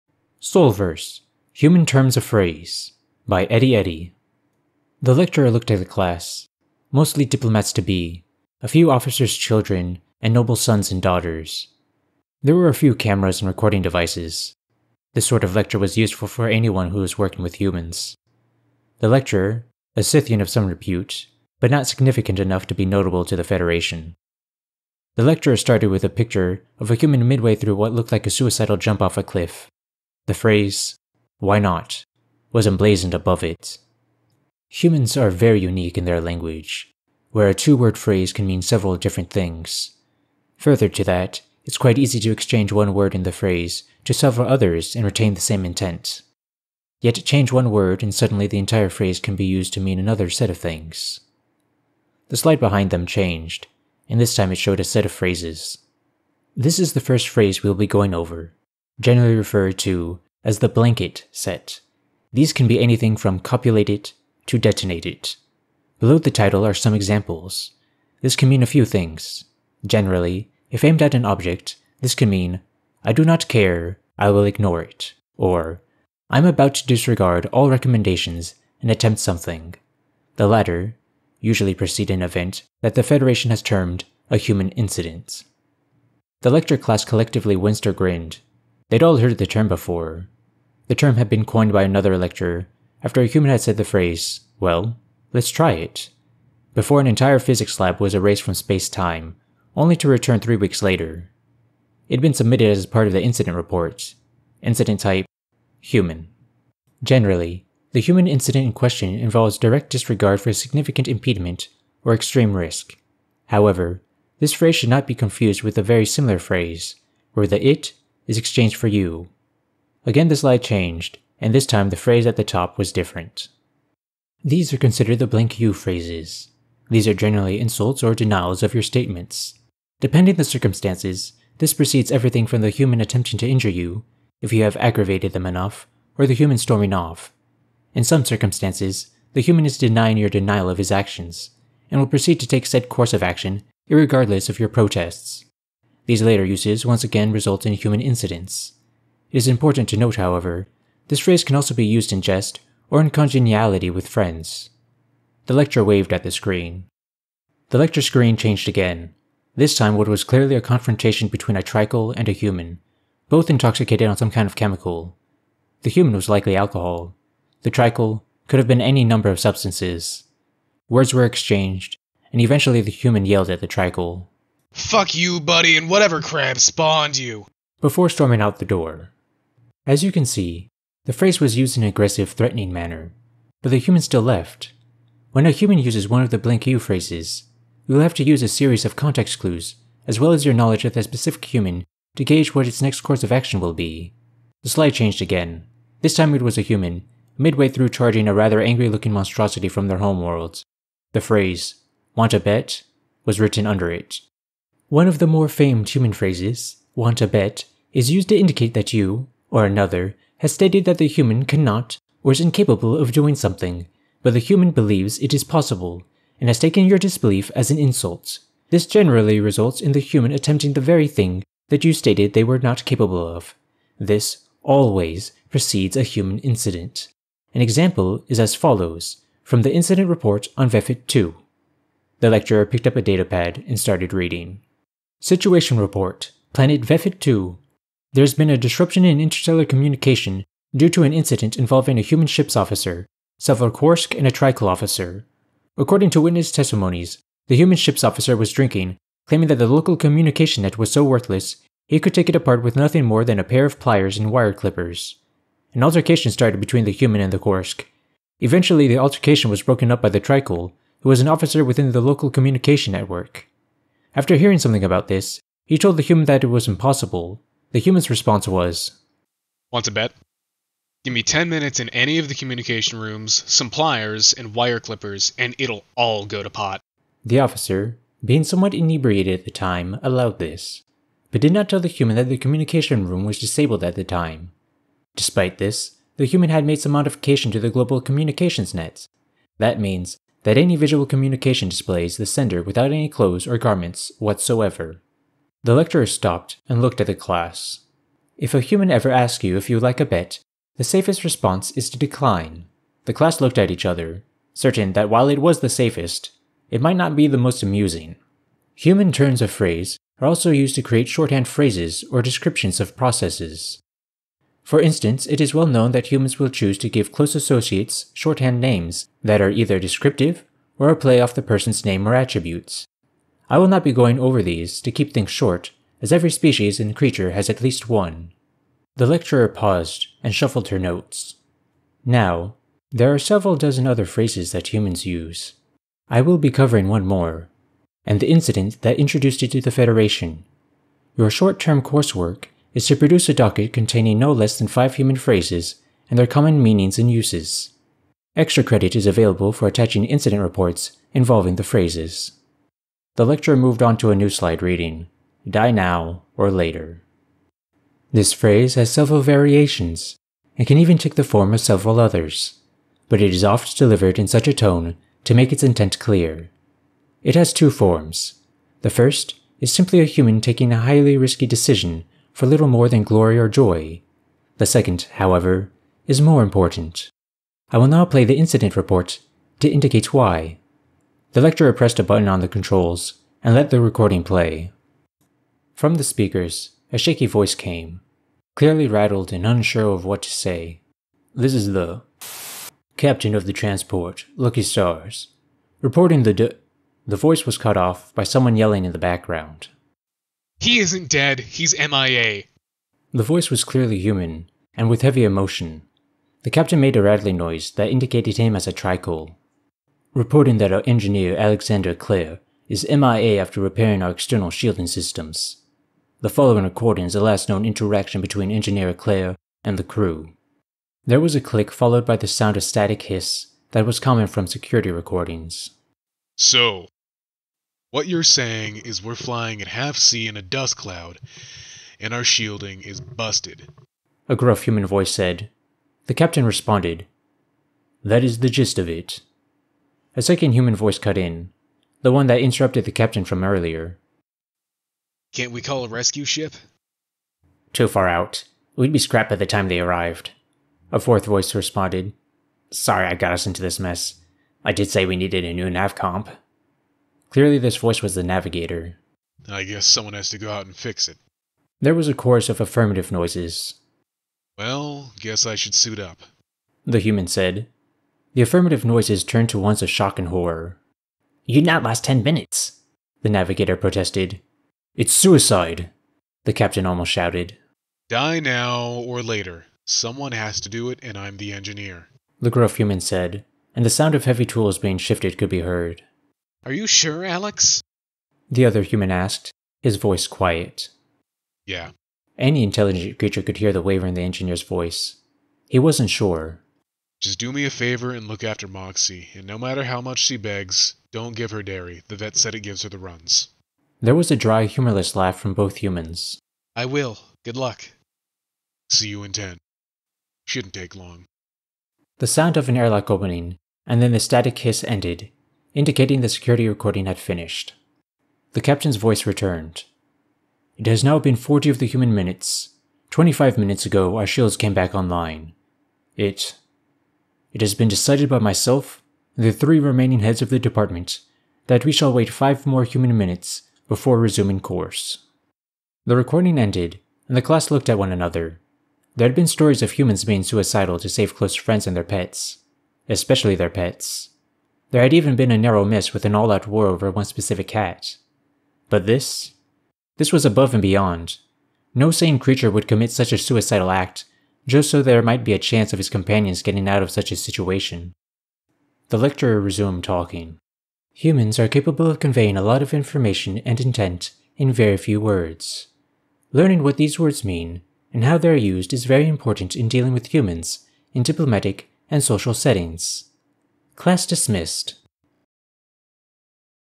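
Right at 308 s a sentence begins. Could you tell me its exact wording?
Human turns of phrase are also used to create shorthand phrases or descriptions of processes.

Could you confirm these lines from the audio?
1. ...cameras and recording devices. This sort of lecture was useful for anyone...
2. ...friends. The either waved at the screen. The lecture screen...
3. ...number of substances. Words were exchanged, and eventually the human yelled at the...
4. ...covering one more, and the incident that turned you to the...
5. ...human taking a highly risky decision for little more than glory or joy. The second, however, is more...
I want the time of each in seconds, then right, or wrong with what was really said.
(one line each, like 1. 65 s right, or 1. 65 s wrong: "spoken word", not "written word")
1. 12 s right
2. 154 s wrong: "lecturer", not "either"
3. 169 s right
4. 336 s wrong: "introduced", not "turned"
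5. 370 s right.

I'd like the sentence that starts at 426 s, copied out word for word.
So, what you're saying is we're flying at half c in a dust cloud, and our shielding is busted.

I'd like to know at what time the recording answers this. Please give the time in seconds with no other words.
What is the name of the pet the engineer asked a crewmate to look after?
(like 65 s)
498 s.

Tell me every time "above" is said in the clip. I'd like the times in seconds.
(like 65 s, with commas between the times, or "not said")
33 s, 550 s.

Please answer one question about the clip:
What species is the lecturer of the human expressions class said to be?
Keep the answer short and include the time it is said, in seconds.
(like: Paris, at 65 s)
Scythian, at 20 s.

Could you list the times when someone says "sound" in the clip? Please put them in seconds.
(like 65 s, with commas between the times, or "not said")
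422 s, 483 s, 512 s.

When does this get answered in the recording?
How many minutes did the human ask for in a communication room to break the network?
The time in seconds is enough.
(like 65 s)
271 s.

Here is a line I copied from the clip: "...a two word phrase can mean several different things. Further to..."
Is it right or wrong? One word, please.
right.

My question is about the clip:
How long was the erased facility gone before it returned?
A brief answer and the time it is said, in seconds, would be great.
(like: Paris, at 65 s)
three weeks, at 100 s.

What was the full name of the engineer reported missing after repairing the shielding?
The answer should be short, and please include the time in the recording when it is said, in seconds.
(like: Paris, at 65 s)
Alexander Clare, at 411 s.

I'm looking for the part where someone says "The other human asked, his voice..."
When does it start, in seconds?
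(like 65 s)
488 s.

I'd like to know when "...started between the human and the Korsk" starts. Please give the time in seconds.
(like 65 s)
256 s.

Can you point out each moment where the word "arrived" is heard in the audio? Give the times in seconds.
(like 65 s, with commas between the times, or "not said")
449 s.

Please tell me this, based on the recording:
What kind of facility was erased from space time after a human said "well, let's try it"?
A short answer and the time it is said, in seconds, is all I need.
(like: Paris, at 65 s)
physics lab, at 97 s.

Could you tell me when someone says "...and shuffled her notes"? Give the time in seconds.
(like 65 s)
330 s.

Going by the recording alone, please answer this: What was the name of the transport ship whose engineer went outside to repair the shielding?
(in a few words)
Lucky Stars.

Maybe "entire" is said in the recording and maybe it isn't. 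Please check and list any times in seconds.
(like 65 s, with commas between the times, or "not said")
48 s, 97 s.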